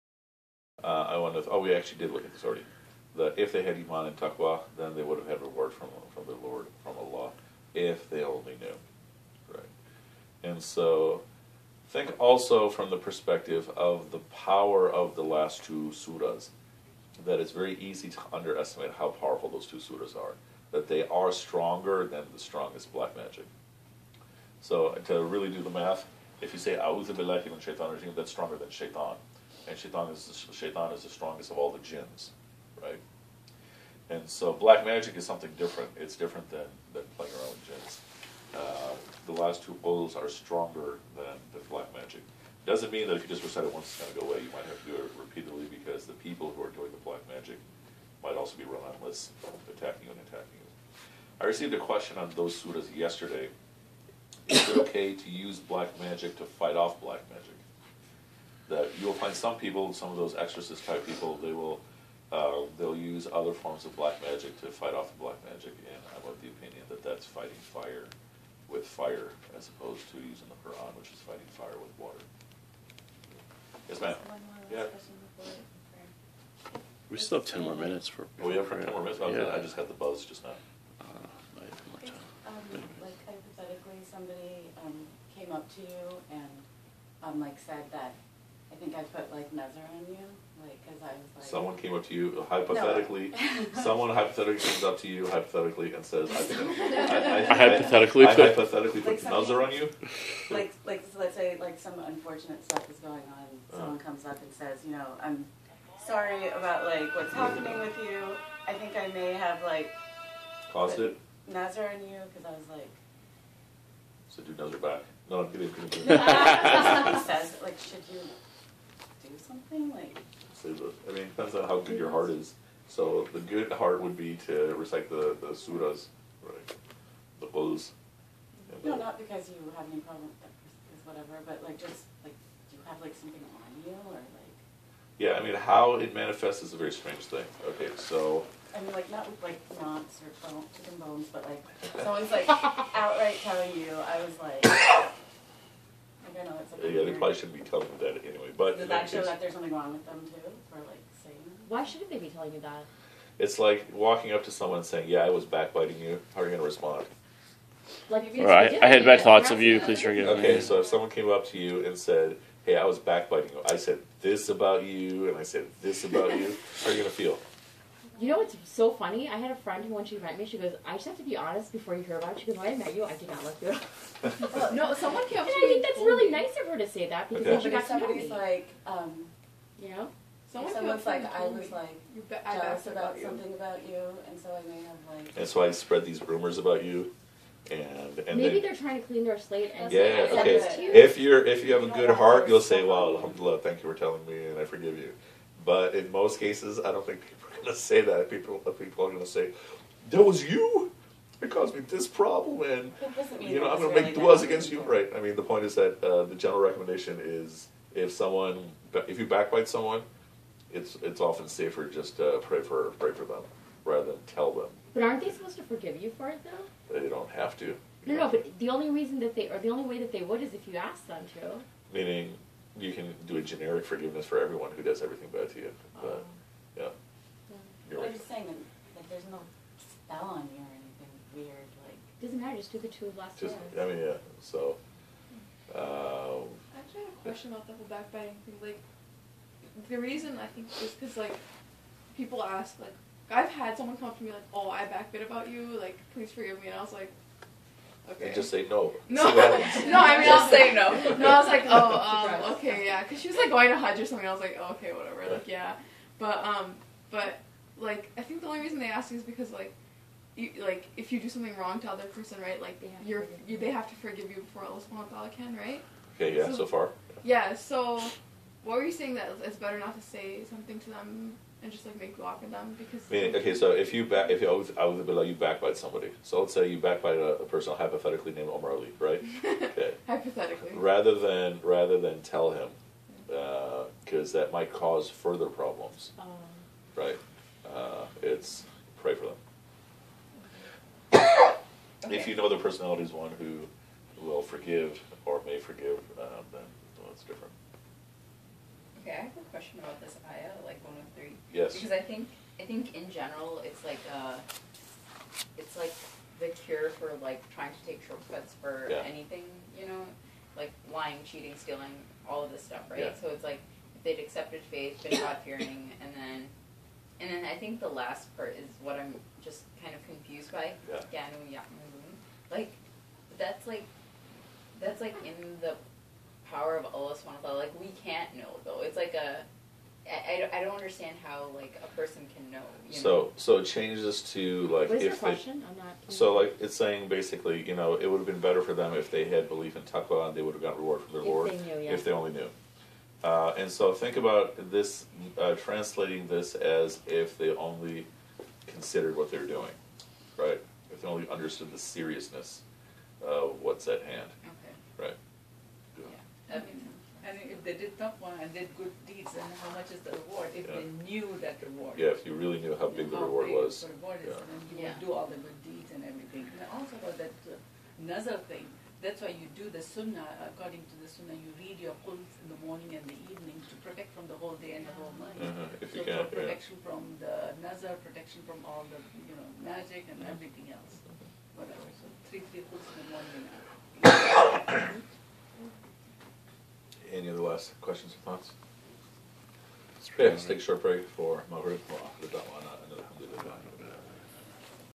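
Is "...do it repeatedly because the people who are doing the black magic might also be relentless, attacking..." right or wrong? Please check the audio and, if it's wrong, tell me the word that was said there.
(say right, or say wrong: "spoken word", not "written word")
right.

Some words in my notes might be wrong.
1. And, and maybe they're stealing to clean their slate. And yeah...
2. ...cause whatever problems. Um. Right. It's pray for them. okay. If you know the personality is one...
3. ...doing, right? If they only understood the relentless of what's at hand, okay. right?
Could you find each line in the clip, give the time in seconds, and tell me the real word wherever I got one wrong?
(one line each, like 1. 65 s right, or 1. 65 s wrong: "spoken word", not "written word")
1. 187 s wrong: "trying", not "stealing"
2. 284 s wrong: "further", not "whatever"
3. 349 s wrong: "seriousness", not "relentless".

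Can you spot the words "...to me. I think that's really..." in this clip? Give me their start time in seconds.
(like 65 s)
175 s.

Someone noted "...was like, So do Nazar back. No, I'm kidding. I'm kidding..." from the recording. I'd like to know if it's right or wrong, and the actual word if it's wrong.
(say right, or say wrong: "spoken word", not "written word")
right.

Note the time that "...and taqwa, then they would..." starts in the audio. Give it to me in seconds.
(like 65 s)
4 s.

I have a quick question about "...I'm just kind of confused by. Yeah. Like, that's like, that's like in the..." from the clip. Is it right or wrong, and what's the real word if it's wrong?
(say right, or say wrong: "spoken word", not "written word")
right.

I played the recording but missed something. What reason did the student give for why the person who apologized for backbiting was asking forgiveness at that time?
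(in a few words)
going to Hajj.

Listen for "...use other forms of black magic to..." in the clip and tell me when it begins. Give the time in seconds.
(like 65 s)
62 s.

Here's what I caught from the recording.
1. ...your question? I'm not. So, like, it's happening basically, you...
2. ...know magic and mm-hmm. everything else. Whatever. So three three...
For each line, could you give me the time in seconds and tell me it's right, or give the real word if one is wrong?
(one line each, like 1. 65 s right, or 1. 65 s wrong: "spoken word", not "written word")
1. 335 s wrong: "saying", not "happening"
2. 379 s right.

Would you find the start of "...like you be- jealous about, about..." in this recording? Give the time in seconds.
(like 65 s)
181 s.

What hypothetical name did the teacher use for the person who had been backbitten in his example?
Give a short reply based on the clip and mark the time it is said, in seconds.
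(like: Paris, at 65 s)
Umar Ali, at 278 s.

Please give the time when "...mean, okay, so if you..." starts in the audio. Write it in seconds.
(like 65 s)
273 s.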